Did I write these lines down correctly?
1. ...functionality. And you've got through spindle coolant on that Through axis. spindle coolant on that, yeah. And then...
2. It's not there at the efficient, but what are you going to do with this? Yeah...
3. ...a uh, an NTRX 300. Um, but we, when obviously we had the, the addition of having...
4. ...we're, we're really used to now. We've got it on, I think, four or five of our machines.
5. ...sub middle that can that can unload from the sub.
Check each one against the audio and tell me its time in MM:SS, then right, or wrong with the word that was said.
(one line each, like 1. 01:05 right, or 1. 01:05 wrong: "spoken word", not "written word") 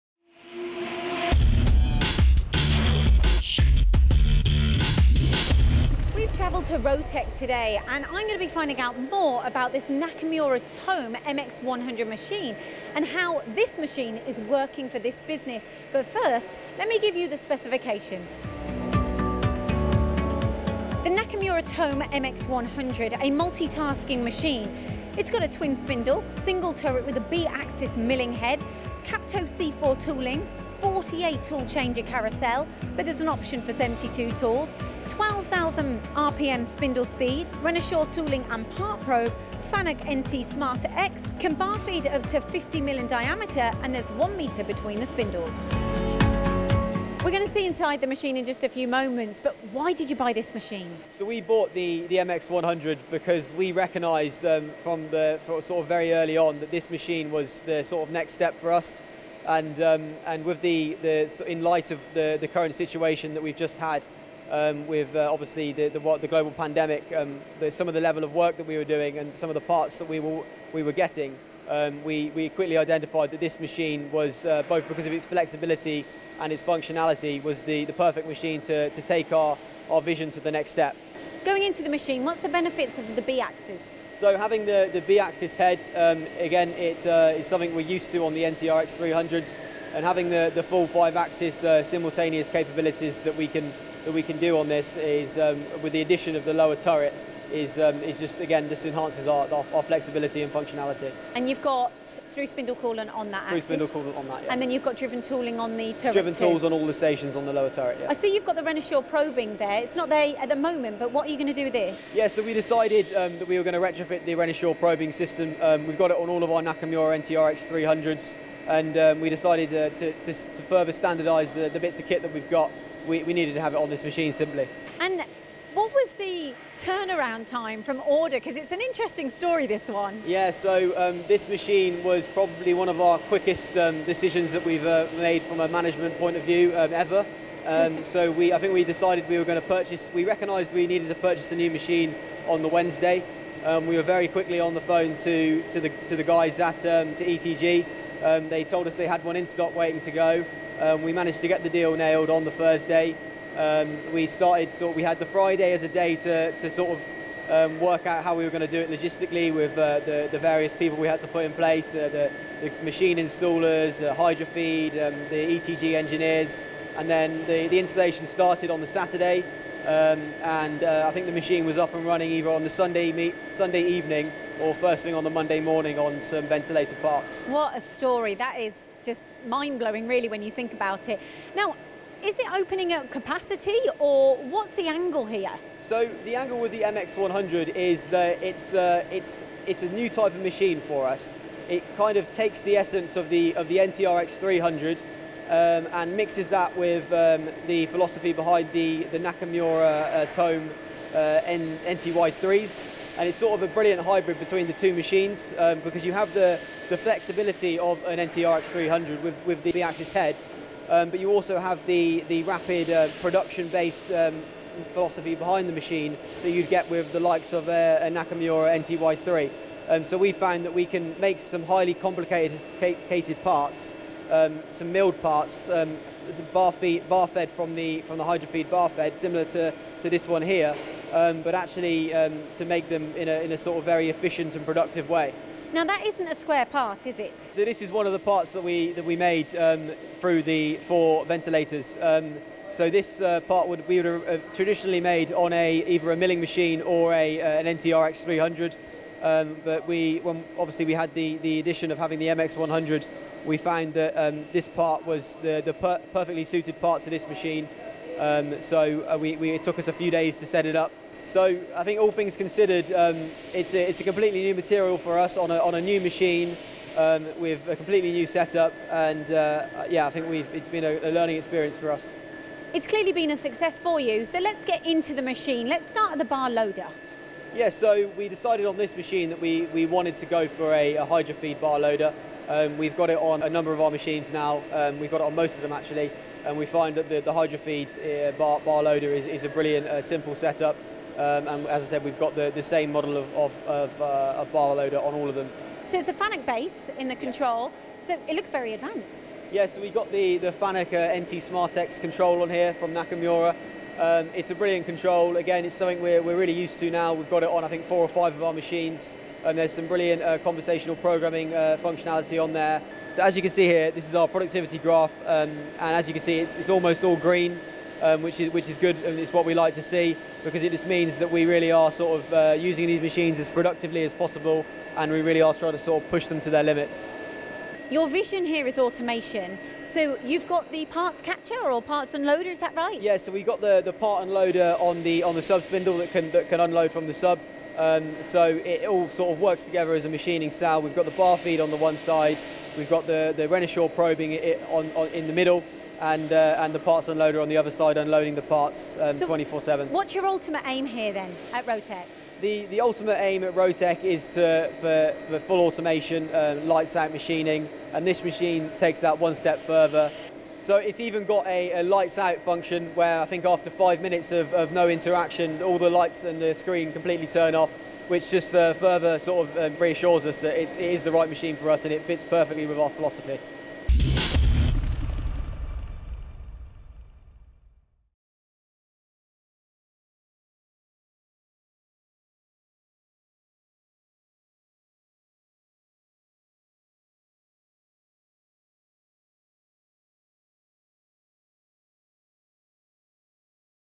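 1. 01:40 right
2. 01:49 wrong: "moment", not "efficient"
3. 04:07 right
4. 05:06 right
5. 05:35 wrong: "spindle", not "middle".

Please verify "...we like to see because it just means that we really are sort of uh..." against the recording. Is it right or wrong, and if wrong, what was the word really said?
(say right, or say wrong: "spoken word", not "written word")
right.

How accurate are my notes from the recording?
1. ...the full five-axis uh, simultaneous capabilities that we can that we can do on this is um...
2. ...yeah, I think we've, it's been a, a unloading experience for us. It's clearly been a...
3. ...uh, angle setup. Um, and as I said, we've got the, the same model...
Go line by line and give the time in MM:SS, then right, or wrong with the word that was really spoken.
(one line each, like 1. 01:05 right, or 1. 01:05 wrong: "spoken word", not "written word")
1. 01:30 right
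2. 04:29 wrong: "learning", not "unloading"
3. 04:49 wrong: "simple", not "angle".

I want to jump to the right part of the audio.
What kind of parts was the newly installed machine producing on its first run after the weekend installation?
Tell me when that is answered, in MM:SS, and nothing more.
02:56.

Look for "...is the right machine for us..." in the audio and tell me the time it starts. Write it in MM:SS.
06:10.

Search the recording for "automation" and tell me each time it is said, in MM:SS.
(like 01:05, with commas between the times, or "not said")
05:28, 05:55.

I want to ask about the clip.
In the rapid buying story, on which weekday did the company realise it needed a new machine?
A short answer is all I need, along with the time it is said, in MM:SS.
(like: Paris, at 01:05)
Wednesday, at 02:22.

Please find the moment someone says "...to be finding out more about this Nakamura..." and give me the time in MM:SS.
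00:08.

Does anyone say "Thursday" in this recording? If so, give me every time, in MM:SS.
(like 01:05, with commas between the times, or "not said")
02:32.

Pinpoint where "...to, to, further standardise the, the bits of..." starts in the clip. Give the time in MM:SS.
02:00.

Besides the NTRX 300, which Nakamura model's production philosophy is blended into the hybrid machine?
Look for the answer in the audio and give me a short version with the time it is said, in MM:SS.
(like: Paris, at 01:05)
NTY3, at 03:21.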